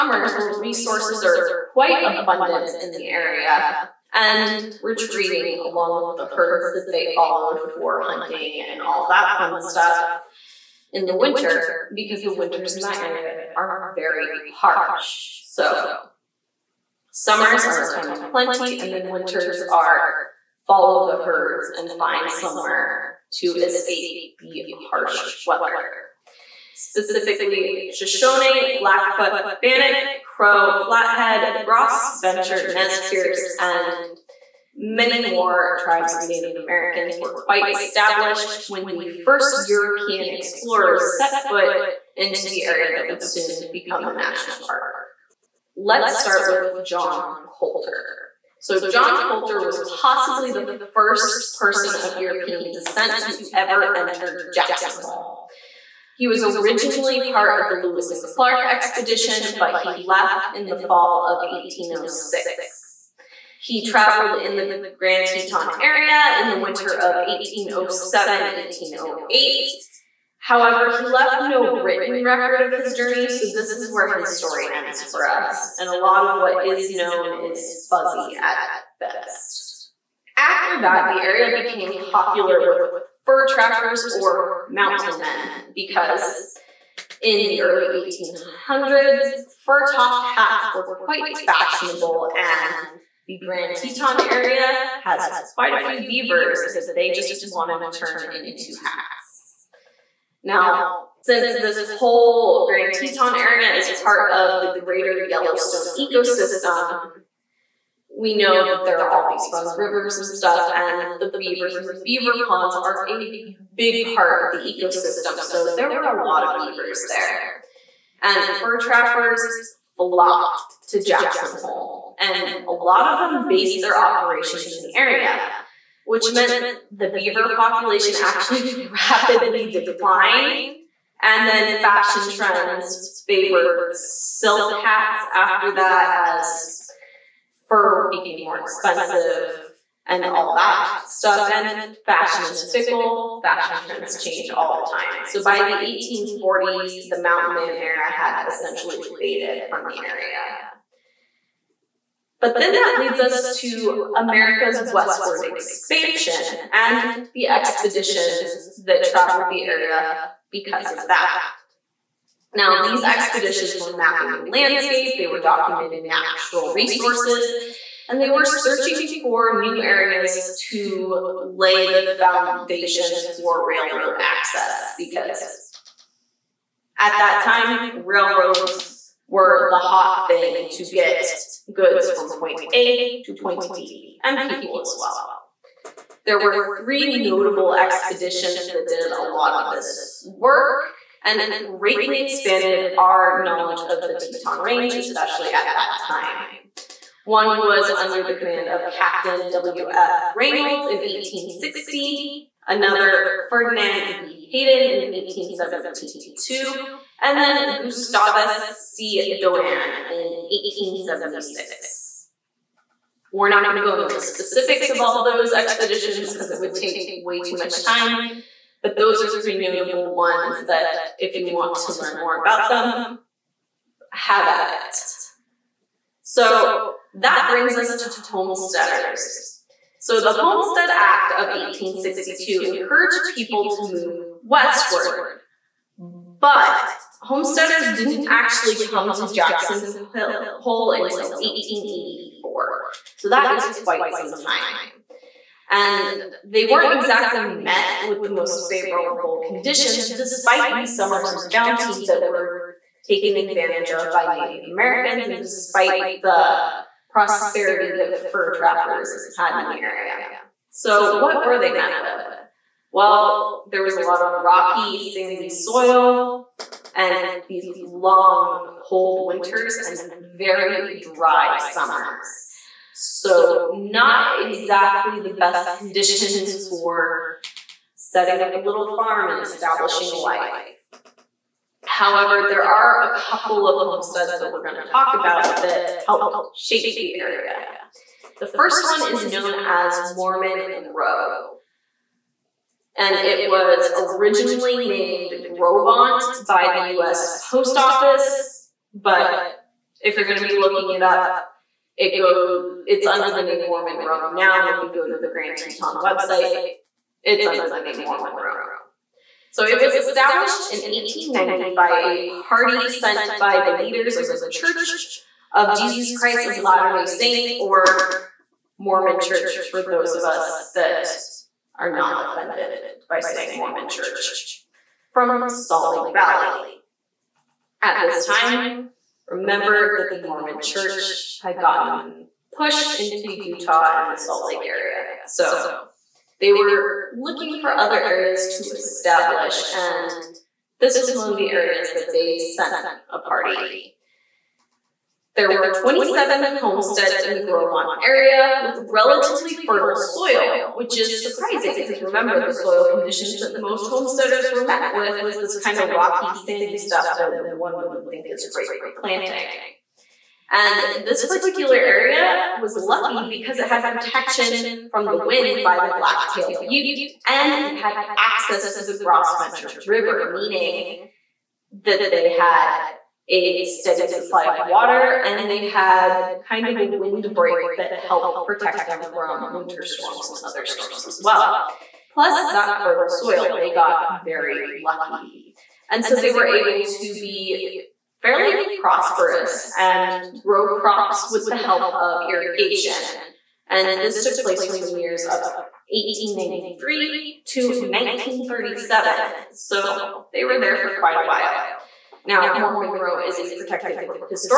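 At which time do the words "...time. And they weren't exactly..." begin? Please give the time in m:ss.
4:04.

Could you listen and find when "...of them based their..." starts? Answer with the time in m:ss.
2:03.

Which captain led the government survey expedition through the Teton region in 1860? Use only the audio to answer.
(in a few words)
W.F. Reynolds.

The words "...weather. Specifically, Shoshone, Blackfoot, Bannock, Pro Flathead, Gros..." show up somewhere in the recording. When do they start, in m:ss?
0:25.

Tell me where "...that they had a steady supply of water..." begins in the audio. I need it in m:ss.
6:11.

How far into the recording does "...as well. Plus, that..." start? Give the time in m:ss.
6:21.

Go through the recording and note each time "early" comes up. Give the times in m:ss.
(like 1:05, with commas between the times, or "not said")
1:27.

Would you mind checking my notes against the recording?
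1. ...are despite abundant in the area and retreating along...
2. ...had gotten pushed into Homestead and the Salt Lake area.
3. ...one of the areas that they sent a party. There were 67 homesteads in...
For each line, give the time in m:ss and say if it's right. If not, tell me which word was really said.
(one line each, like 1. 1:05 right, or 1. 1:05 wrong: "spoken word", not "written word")
1. 0:01 wrong: "quite", not "despite"
2. 5:31 wrong: "Utah", not "Homestead"
3. 5:41 wrong: "27", not "67".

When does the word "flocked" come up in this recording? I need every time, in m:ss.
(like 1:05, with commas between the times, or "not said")
1:59.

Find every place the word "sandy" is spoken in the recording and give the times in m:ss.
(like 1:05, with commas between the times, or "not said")
4:24, 5:56.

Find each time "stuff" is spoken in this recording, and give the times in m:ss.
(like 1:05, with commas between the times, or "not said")
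0:09, 1:50, 2:21, 5:56.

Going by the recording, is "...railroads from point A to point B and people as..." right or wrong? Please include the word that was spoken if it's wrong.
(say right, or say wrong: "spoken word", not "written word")
wrong: "goods", not "railroads".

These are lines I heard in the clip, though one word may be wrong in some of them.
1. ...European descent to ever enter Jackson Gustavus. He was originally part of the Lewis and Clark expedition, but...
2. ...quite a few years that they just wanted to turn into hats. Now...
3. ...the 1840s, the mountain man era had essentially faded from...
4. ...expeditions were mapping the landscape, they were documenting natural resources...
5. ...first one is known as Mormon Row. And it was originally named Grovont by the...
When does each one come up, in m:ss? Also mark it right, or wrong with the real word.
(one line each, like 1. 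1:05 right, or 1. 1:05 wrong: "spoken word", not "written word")
1. 0:52 wrong: "Hole", not "Gustavus"
2. 1:35 wrong: "beavers", not "years"
3. 2:25 right
4. 2:43 right
5. 4:48 right.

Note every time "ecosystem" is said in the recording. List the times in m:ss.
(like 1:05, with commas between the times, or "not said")
1:45, 1:54.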